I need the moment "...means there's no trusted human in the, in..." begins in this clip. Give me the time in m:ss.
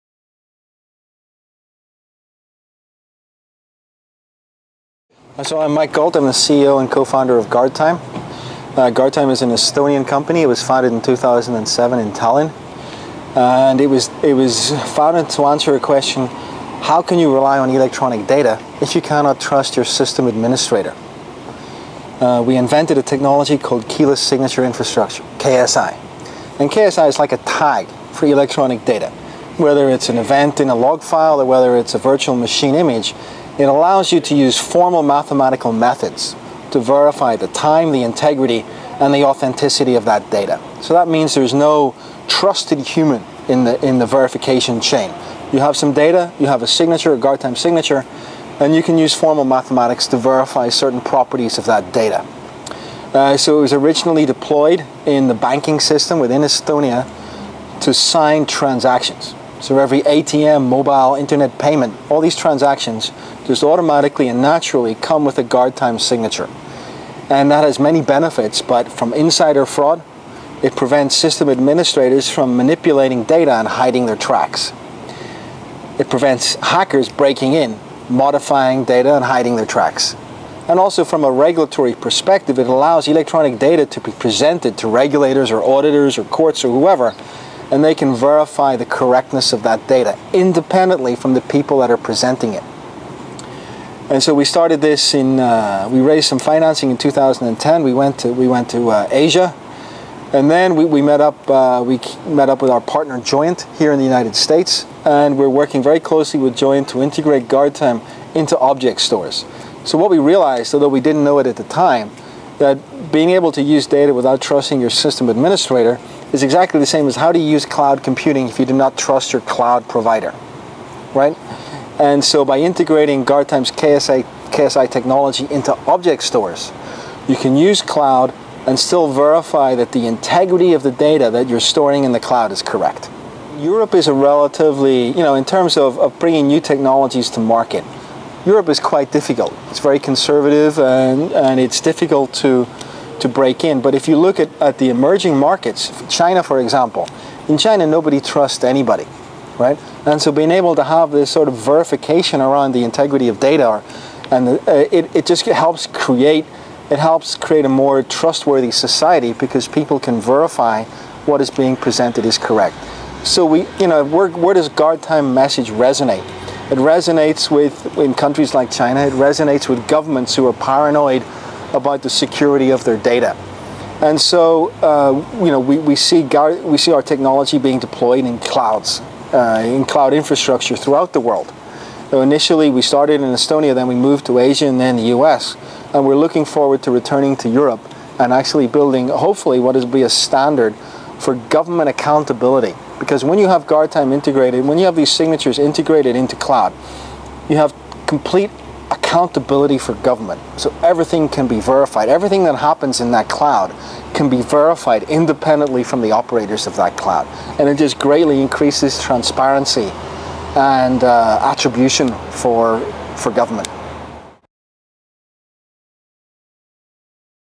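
0:41.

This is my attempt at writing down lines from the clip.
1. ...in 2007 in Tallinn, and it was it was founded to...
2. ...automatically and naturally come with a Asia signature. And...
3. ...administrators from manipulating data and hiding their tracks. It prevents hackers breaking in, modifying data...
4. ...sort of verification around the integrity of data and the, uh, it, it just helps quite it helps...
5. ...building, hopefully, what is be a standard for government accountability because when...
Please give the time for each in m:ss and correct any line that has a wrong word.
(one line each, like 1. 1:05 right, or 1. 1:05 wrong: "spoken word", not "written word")
1. 0:10 right
2. 1:03 wrong: "Guardtime", not "Asia"
3. 1:11 right
4. 2:31 wrong: "create", not "quite"
5. 3:08 right.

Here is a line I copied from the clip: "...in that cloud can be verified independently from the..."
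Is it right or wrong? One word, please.
right.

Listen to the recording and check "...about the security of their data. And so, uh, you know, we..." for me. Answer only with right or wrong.
right.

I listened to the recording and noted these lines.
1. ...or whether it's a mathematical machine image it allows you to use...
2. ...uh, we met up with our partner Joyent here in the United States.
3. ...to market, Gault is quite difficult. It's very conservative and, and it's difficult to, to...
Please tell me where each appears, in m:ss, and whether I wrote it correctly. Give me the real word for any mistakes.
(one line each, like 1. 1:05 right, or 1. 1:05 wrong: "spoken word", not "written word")
1. 0:31 wrong: "virtual", not "mathematical"
2. 1:41 right
3. 2:17 wrong: "Europe", not "Gault".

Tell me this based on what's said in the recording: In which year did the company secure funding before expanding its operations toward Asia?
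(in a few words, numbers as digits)
2010.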